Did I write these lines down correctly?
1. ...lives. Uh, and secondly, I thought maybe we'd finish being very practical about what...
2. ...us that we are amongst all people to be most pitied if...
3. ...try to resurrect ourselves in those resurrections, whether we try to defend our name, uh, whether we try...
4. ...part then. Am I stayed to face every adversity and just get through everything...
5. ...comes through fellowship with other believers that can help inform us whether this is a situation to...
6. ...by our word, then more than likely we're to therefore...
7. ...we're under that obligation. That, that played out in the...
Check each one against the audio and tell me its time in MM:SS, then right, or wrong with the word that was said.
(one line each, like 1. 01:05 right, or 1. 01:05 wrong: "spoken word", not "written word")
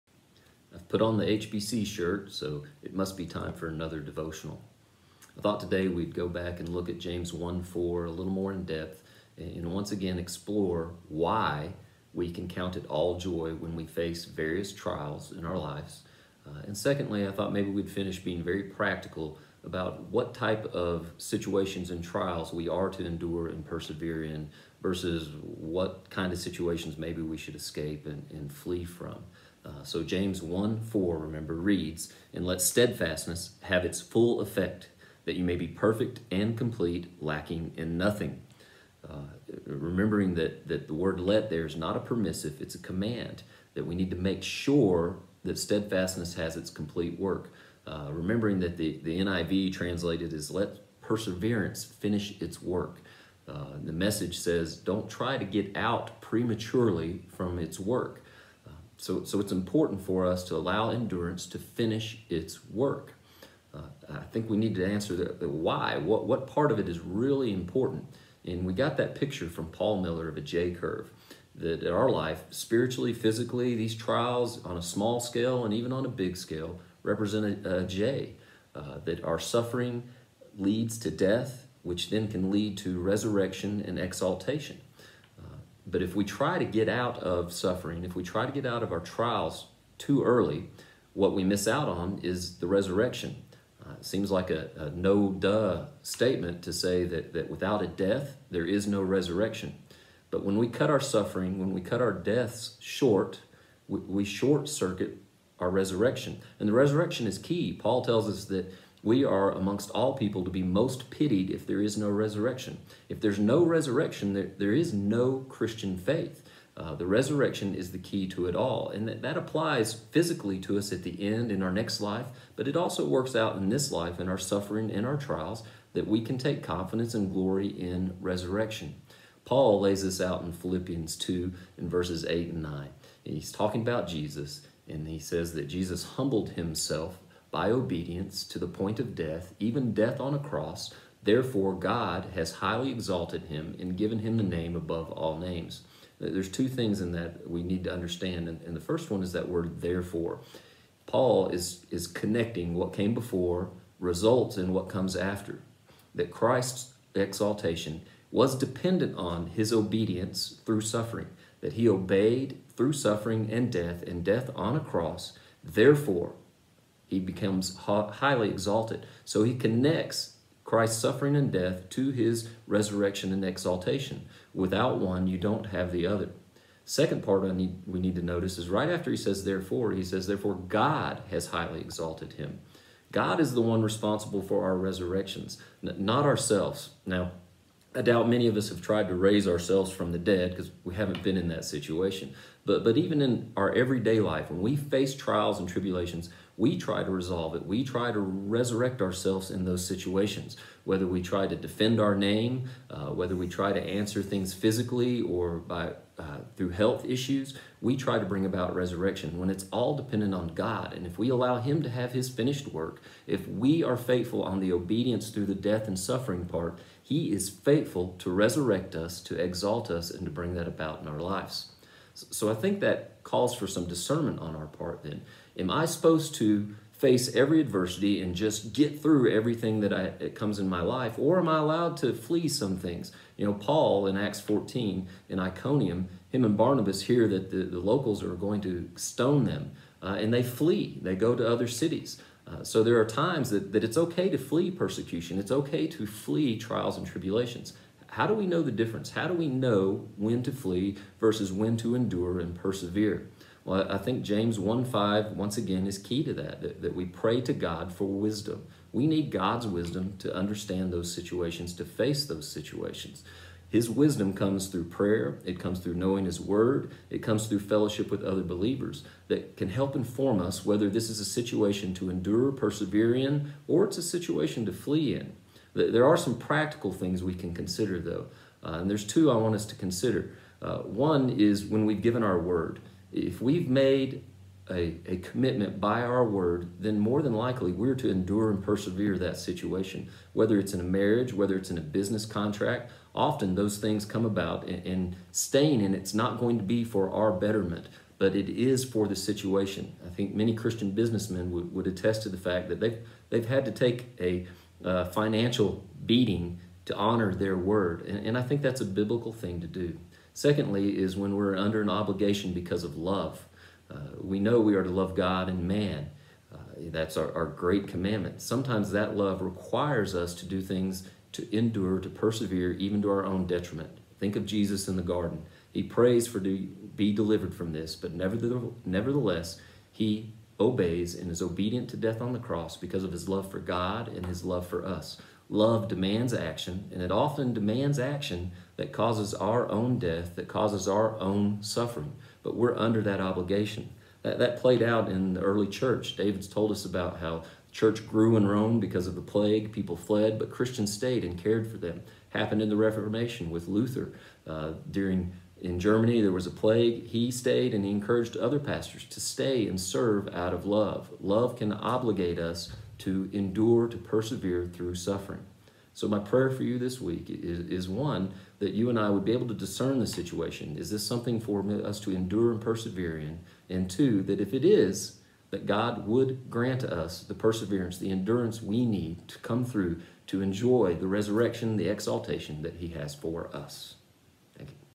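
1. 00:15 right
2. 01:48 right
3. 03:17 wrong: "situations", not "resurrections"
4. 03:44 wrong: "supposed", not "stayed"
5. 04:27 right
6. 04:45 wrong: "endure", not "therefore"
7. 05:42 right.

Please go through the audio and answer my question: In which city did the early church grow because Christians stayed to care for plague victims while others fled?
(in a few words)
Rome.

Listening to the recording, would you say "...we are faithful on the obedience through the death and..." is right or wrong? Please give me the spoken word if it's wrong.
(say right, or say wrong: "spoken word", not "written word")
right.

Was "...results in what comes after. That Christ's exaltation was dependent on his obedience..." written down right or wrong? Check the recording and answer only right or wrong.
right.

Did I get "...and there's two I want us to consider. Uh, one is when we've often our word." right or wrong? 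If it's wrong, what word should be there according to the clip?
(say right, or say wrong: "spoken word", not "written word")
wrong: "given", not "often".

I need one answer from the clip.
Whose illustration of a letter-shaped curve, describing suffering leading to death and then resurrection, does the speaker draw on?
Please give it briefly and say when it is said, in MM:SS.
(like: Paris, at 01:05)
Paul Miller, at 01:09.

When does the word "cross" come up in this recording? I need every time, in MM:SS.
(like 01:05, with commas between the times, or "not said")
02:20, 02:44, 05:32.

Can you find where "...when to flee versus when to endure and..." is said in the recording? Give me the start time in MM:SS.
04:10.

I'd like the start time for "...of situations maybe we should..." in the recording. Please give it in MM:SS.
00:26.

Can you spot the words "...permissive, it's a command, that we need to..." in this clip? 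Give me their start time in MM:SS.
00:41.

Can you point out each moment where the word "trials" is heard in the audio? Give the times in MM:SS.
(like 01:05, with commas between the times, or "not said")
00:14, 00:22, 01:13, 01:29, 02:05, 03:15, 04:06.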